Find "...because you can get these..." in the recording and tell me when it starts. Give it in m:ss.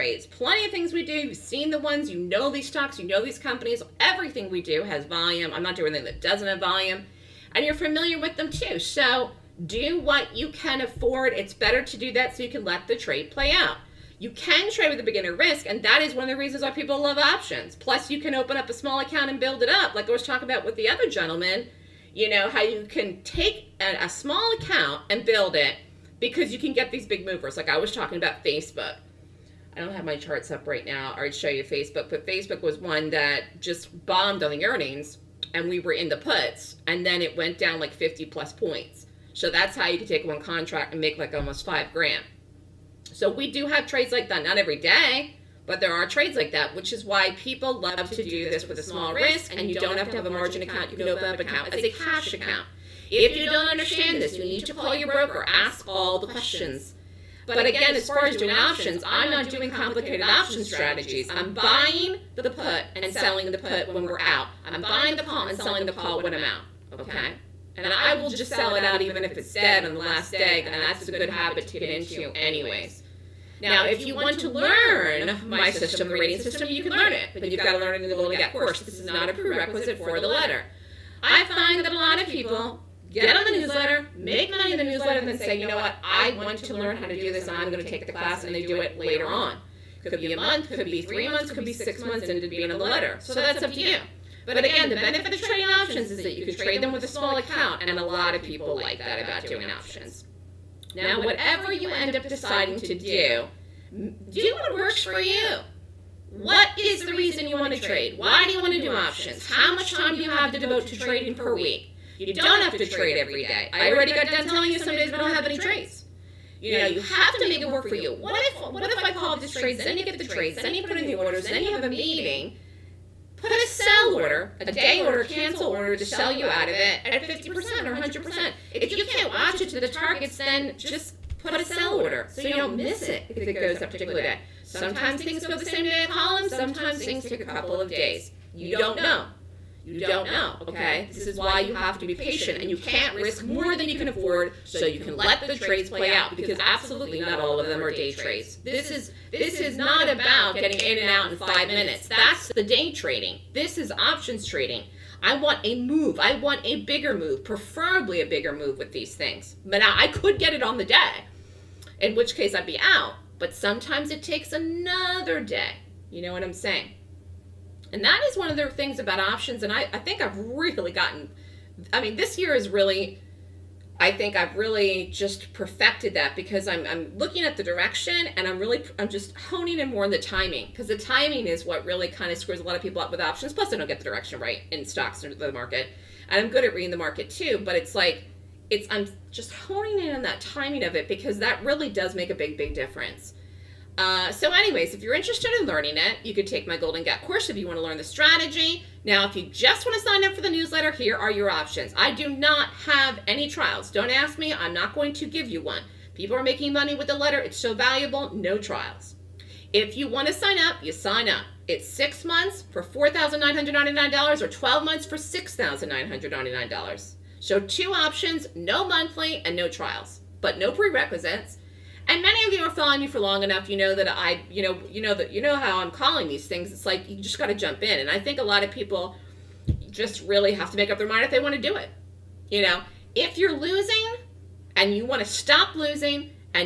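0:26.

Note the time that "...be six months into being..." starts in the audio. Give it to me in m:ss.
1:31.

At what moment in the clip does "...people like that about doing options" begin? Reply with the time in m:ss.
1:38.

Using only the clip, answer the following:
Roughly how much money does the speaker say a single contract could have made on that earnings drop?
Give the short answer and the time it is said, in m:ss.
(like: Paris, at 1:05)
almost 5 grand, at 0:41.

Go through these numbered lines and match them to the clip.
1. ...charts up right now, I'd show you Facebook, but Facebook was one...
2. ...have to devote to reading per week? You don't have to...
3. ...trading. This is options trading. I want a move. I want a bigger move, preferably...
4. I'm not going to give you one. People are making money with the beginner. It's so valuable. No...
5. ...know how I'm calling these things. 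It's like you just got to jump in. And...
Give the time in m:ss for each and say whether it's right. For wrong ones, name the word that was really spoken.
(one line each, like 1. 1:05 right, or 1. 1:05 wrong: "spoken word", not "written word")
1. 0:30 right
2. 1:50 wrong: "trading", not "reading"
3. 2:32 right
4. 3:24 wrong: "letter", not "beginner"
5. 3:45 right.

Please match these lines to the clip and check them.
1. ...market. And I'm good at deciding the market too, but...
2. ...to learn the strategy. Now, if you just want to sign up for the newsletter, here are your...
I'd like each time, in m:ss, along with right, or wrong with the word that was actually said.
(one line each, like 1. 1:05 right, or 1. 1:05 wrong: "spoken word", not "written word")
1. 3:05 wrong: "reading", not "deciding"
2. 3:17 right.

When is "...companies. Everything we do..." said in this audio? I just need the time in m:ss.
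0:03.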